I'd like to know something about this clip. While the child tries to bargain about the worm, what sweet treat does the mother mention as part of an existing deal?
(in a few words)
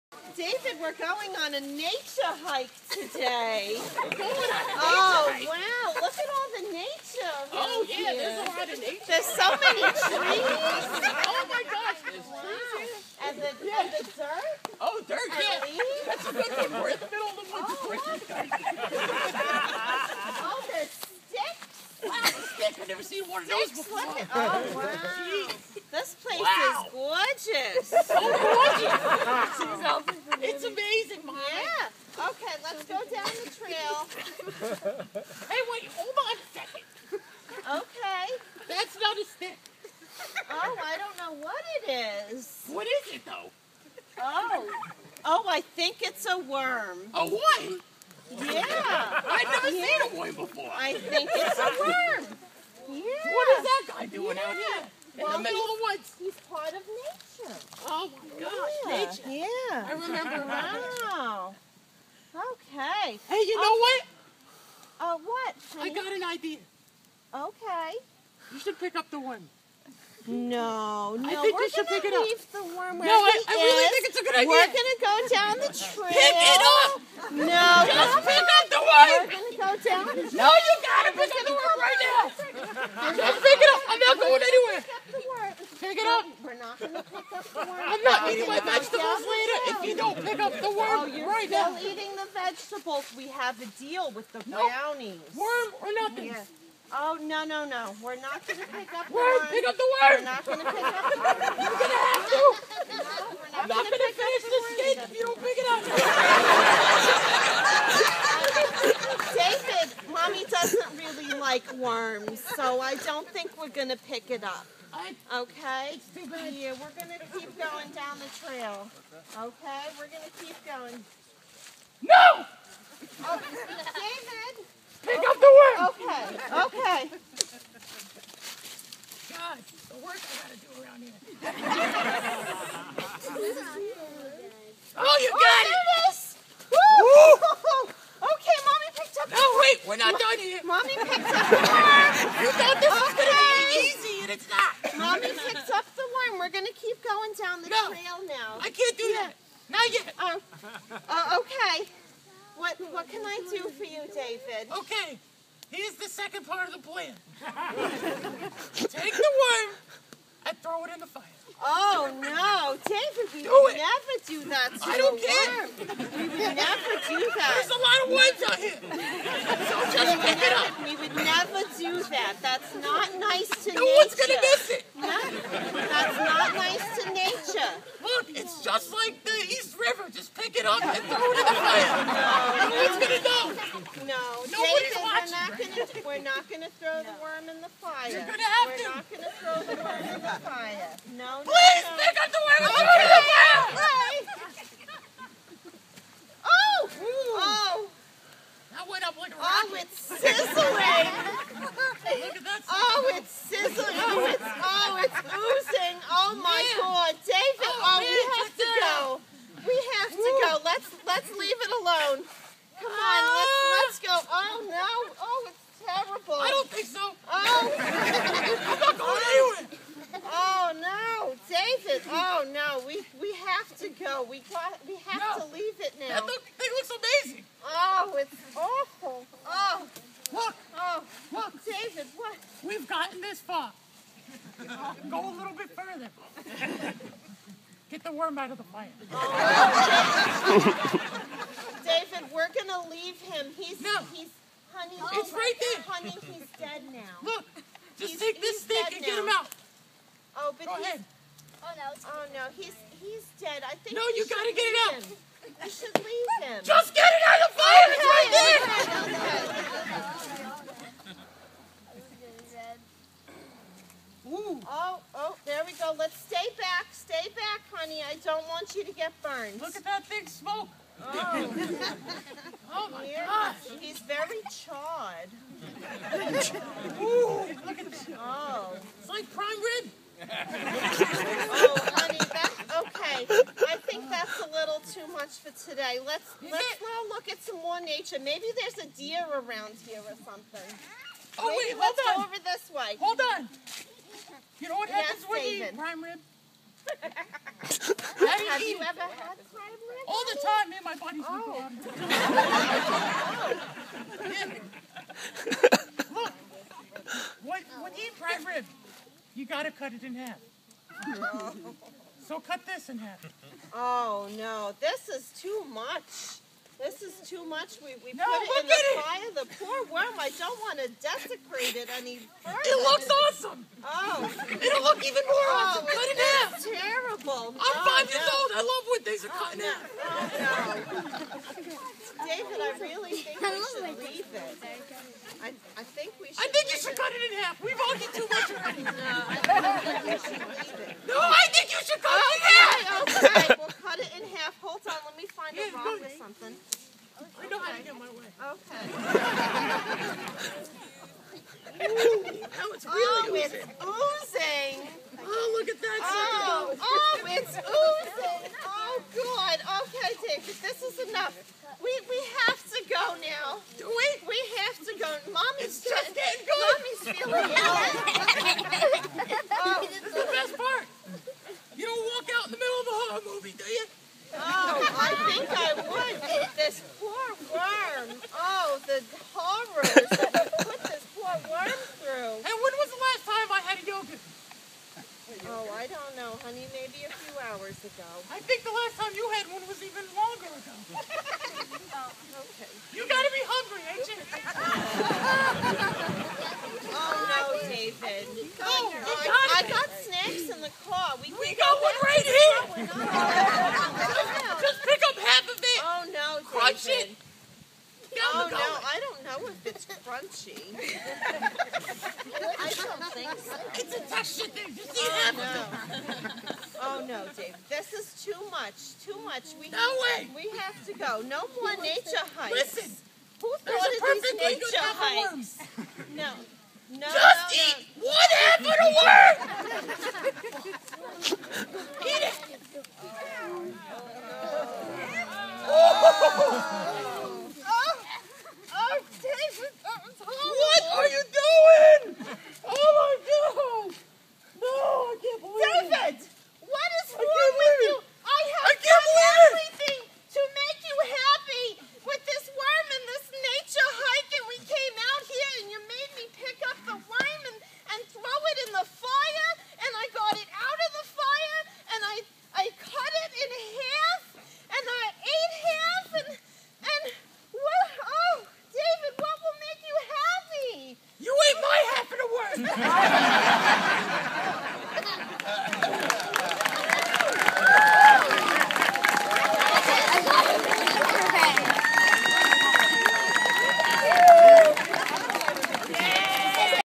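brownies.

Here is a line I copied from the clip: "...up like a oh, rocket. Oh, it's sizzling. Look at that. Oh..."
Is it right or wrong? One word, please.
right.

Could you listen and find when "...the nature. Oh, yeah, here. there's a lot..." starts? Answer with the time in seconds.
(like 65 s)
6 s.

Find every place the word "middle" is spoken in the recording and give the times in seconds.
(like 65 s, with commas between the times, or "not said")
17 s, 55 s.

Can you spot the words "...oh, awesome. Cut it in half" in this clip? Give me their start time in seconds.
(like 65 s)
325 s.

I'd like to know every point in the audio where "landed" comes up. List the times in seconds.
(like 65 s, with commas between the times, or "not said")
not said.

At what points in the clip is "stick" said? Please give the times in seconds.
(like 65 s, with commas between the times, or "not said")
39 s, 248 s.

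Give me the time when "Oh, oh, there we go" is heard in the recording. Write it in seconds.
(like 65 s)
264 s.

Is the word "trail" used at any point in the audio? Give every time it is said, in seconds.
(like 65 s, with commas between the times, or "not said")
33 s, 75 s, 118 s, 147 s.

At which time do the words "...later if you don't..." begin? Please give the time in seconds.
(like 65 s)
89 s.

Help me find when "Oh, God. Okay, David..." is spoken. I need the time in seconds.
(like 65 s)
358 s.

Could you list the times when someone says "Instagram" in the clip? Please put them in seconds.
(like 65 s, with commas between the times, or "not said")
not said.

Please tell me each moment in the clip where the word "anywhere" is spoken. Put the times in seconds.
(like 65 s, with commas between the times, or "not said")
84 s, 219 s.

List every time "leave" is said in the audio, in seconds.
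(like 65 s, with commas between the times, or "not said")
15 s, 72 s, 211 s, 225 s, 242 s, 255 s, 334 s, 340 s.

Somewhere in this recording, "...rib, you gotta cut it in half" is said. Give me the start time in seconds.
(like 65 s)
308 s.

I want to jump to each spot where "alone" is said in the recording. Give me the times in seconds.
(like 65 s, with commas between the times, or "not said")
211 s.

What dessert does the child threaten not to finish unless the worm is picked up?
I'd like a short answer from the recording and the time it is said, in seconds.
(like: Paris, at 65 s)
cake, at 104 s.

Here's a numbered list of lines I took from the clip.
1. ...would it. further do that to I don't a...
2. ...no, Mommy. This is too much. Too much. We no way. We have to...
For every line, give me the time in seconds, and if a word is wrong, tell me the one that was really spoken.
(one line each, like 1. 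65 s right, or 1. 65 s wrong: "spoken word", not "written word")
1. 163 s wrong: "never", not "further"
2. 417 s wrong: "Dave", not "Mommy".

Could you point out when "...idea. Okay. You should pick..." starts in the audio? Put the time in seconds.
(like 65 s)
66 s.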